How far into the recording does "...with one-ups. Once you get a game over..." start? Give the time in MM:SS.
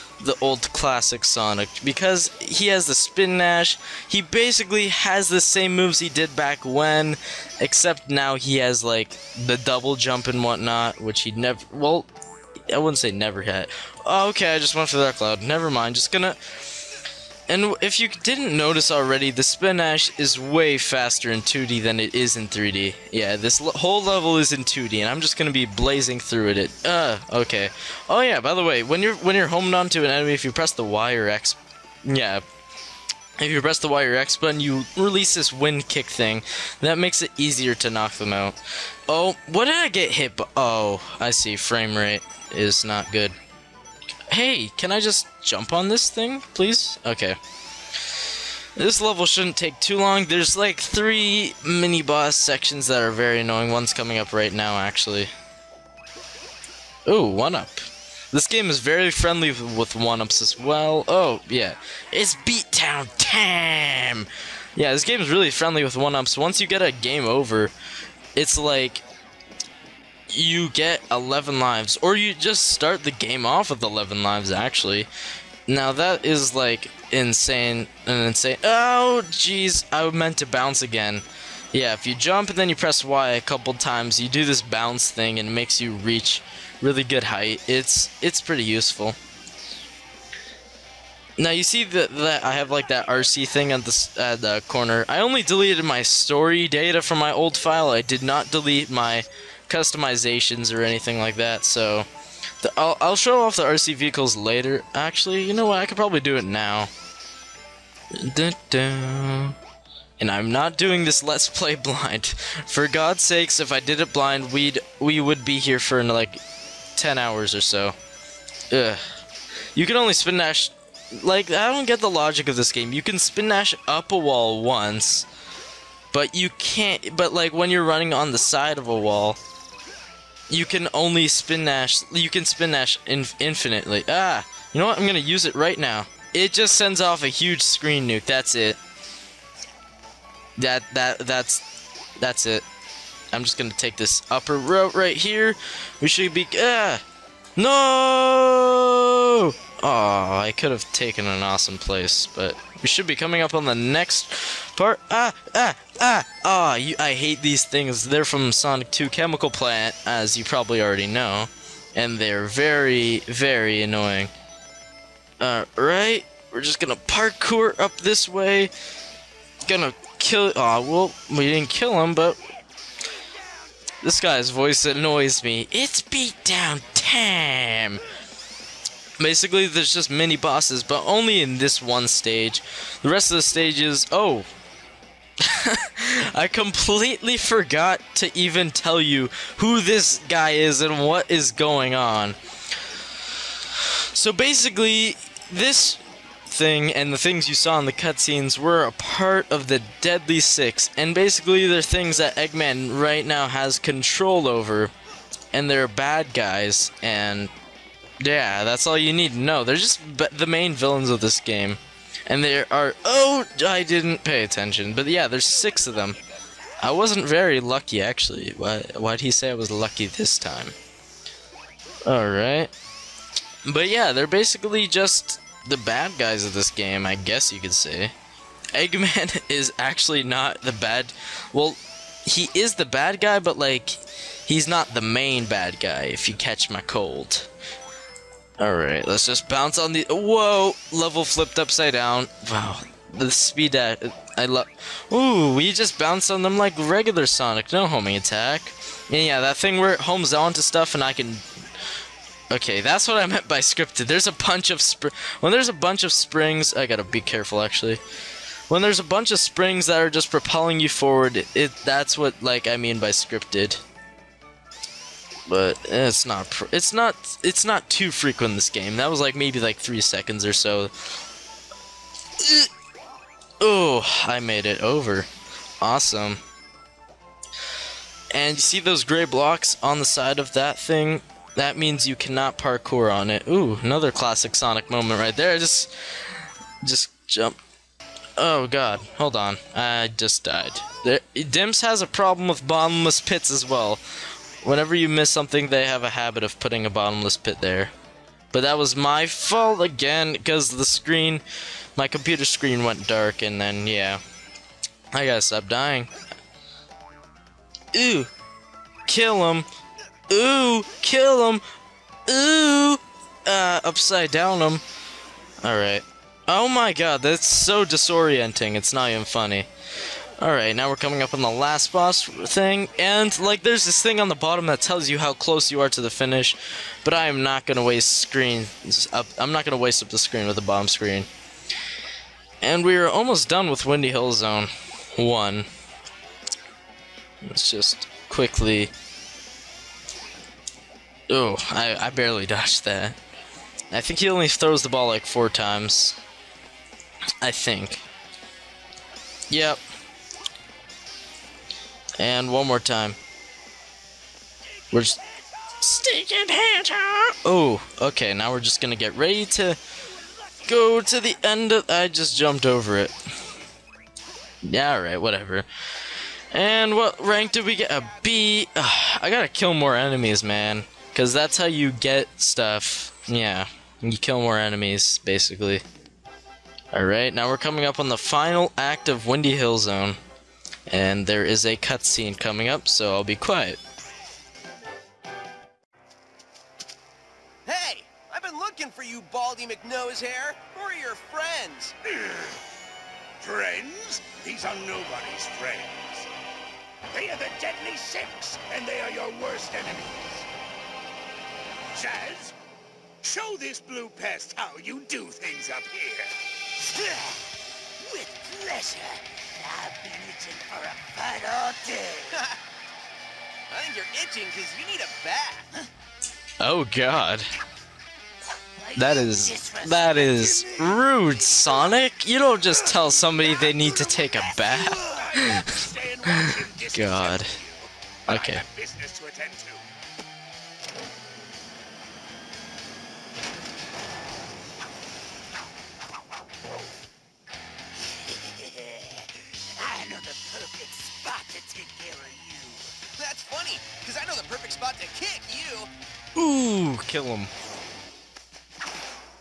01:05.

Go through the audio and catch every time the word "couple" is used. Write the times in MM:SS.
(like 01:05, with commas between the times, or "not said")
01:23.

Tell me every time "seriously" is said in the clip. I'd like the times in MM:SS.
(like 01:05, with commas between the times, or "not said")
not said.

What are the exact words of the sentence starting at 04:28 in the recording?
That was like maybe like three seconds or so.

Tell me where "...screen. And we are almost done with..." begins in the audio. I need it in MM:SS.
05:30.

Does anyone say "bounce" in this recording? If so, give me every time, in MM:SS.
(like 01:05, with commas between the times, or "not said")
01:20, 01:24, 03:59, 04:05.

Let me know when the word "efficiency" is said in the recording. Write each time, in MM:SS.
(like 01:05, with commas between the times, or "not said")
not said.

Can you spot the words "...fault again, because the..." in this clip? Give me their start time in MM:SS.
04:59.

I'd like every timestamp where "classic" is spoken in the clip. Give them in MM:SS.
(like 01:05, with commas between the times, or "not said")
00:00, 04:44.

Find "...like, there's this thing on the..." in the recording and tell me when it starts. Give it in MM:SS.
05:23.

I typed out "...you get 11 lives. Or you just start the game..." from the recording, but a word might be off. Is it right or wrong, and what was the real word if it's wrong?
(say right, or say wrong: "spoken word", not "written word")
right.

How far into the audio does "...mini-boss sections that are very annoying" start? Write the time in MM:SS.
00:51.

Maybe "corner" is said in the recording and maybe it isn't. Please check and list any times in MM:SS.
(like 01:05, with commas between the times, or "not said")
01:34.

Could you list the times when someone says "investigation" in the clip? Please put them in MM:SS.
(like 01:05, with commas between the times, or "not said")
not said.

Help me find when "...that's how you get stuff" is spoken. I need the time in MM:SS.
06:11.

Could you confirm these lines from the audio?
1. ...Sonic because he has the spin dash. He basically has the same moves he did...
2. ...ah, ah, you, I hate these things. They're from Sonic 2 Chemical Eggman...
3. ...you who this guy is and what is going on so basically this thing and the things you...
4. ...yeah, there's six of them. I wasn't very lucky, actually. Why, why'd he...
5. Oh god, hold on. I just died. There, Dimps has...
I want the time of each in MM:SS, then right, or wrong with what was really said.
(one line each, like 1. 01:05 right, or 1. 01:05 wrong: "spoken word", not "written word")
1. 00:01 right
2. 02:35 wrong: "Plant", not "Eggman"
3. 03:08 right
4. 03:35 right
5. 04:48 right.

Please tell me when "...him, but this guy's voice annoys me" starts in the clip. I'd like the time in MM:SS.
02:52.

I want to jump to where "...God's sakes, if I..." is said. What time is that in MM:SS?
01:52.